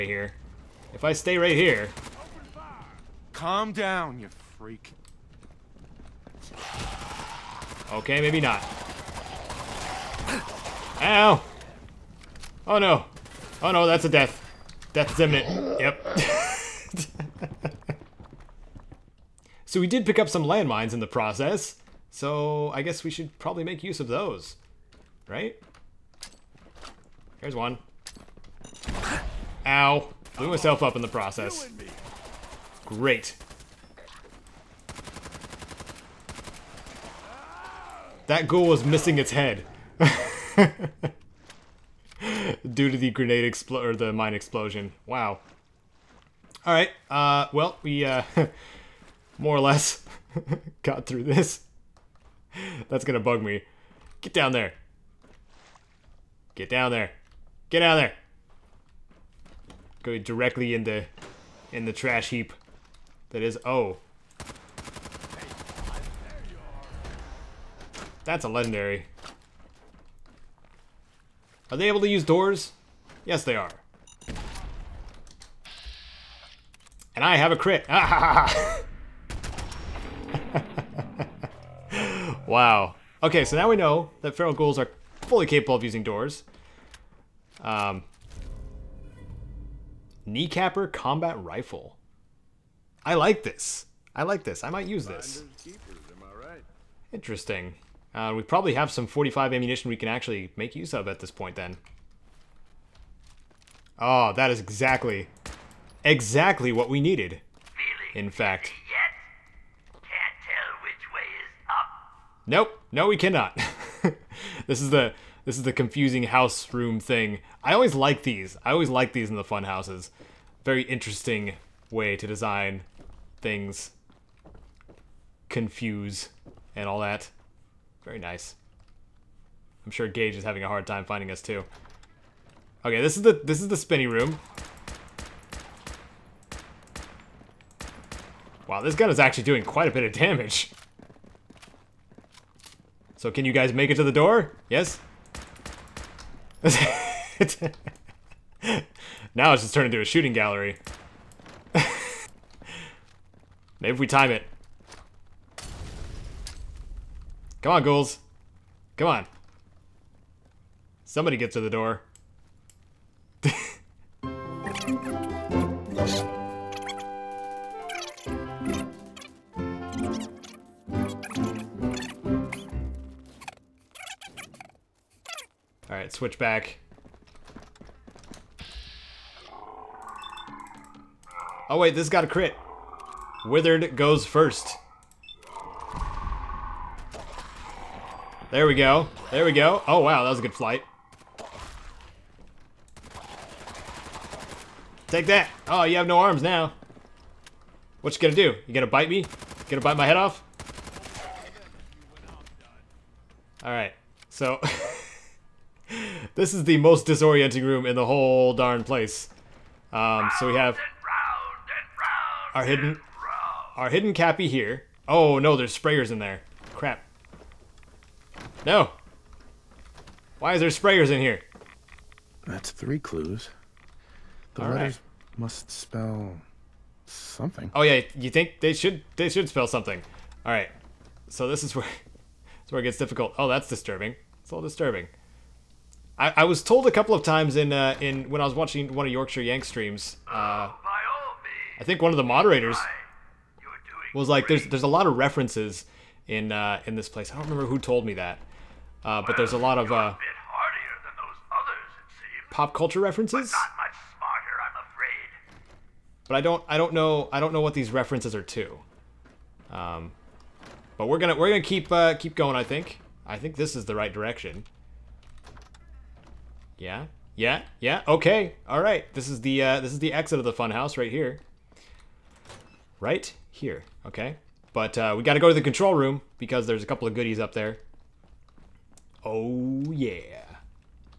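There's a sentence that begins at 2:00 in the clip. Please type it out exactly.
Very interesting way to design things confuse and all that.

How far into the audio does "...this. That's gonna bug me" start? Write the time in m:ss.
0:51.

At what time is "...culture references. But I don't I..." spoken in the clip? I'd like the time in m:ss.
4:12.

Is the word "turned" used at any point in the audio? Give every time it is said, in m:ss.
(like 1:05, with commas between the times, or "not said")
2:29.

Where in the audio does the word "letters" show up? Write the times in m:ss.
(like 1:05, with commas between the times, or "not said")
3:44.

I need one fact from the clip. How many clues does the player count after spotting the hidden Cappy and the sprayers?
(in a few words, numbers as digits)
3.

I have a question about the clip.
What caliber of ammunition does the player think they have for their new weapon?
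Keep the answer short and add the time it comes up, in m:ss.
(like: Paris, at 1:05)
45, at 1:39.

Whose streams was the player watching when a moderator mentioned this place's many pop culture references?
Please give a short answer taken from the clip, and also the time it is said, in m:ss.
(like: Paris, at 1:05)
Yorkshire Yank, at 3:59.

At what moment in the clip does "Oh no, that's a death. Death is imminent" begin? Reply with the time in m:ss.
0:13.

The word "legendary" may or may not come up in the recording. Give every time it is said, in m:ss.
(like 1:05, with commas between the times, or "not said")
1:08.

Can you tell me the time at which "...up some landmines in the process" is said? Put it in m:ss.
0:20.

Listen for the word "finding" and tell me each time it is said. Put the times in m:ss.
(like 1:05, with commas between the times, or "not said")
2:11.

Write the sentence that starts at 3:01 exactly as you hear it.
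Oh wait, this got a crit.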